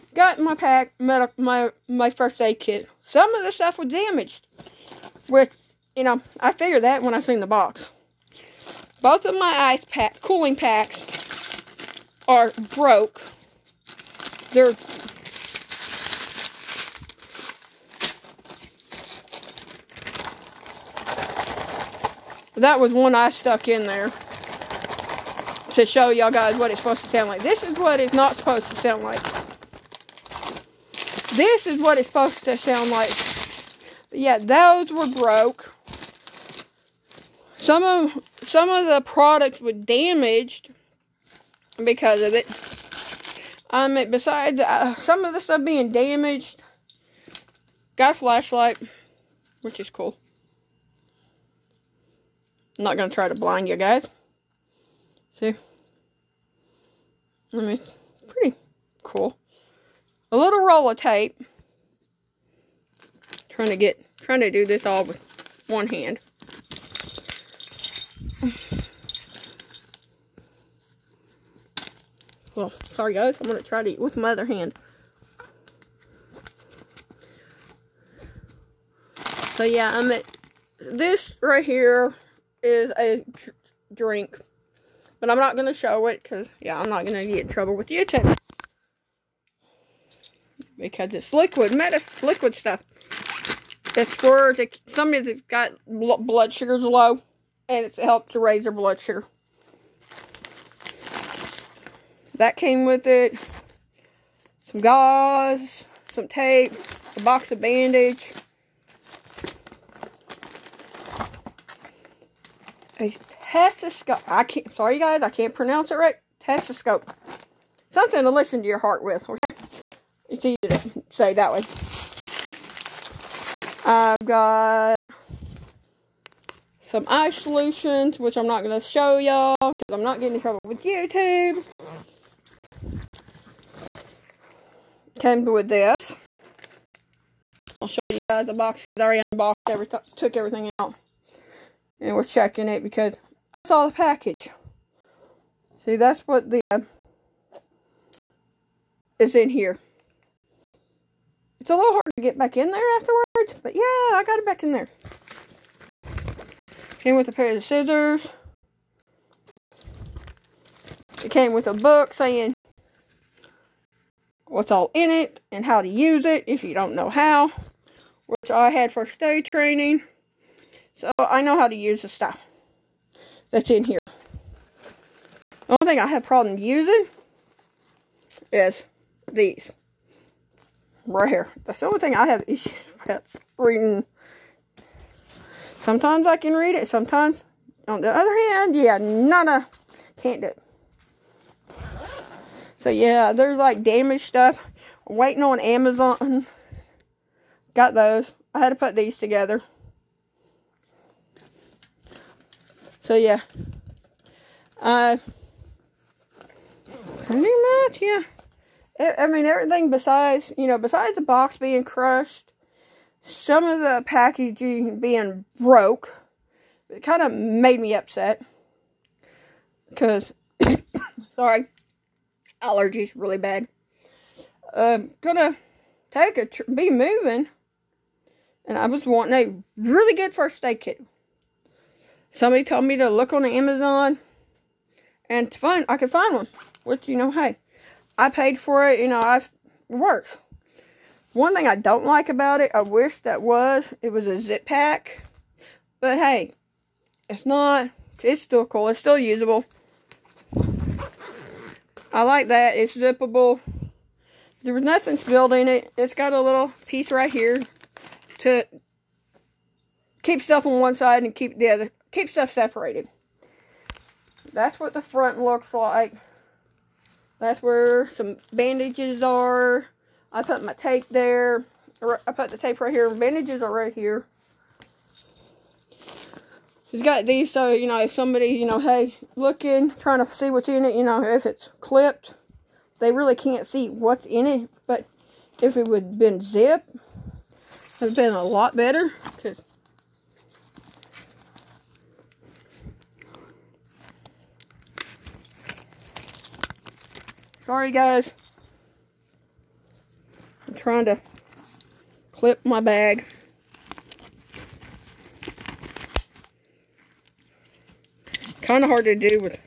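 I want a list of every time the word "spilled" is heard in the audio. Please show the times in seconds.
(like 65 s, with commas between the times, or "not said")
255 s.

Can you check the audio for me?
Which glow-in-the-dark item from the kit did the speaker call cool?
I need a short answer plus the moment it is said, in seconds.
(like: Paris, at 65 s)
Flashlight, at 48 s.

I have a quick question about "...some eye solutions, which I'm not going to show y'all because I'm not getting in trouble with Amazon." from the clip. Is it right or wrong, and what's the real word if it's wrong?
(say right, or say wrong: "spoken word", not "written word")
wrong: "YouTube", not "Amazon".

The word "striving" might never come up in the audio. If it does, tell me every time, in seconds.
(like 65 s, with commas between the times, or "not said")
not said.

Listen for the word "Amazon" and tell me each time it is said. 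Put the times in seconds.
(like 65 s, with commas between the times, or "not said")
195 s, 233 s.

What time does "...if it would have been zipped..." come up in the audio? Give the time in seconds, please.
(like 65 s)
285 s.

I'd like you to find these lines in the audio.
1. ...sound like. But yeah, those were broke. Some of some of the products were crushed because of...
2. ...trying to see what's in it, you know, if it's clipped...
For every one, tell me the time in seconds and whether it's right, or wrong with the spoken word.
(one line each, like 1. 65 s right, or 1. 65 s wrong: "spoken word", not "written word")
1. 32 s wrong: "damaged", not "crushed"
2. 279 s right.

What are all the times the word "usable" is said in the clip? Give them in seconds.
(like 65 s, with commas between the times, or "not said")
249 s.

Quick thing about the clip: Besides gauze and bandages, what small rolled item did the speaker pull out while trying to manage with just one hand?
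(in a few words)
Roll of tape.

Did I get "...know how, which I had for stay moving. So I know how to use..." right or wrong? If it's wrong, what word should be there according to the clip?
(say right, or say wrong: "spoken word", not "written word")
wrong: "training", not "moving".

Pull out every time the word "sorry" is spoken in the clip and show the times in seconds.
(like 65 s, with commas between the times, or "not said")
72 s, 114 s, 221 s, 297 s.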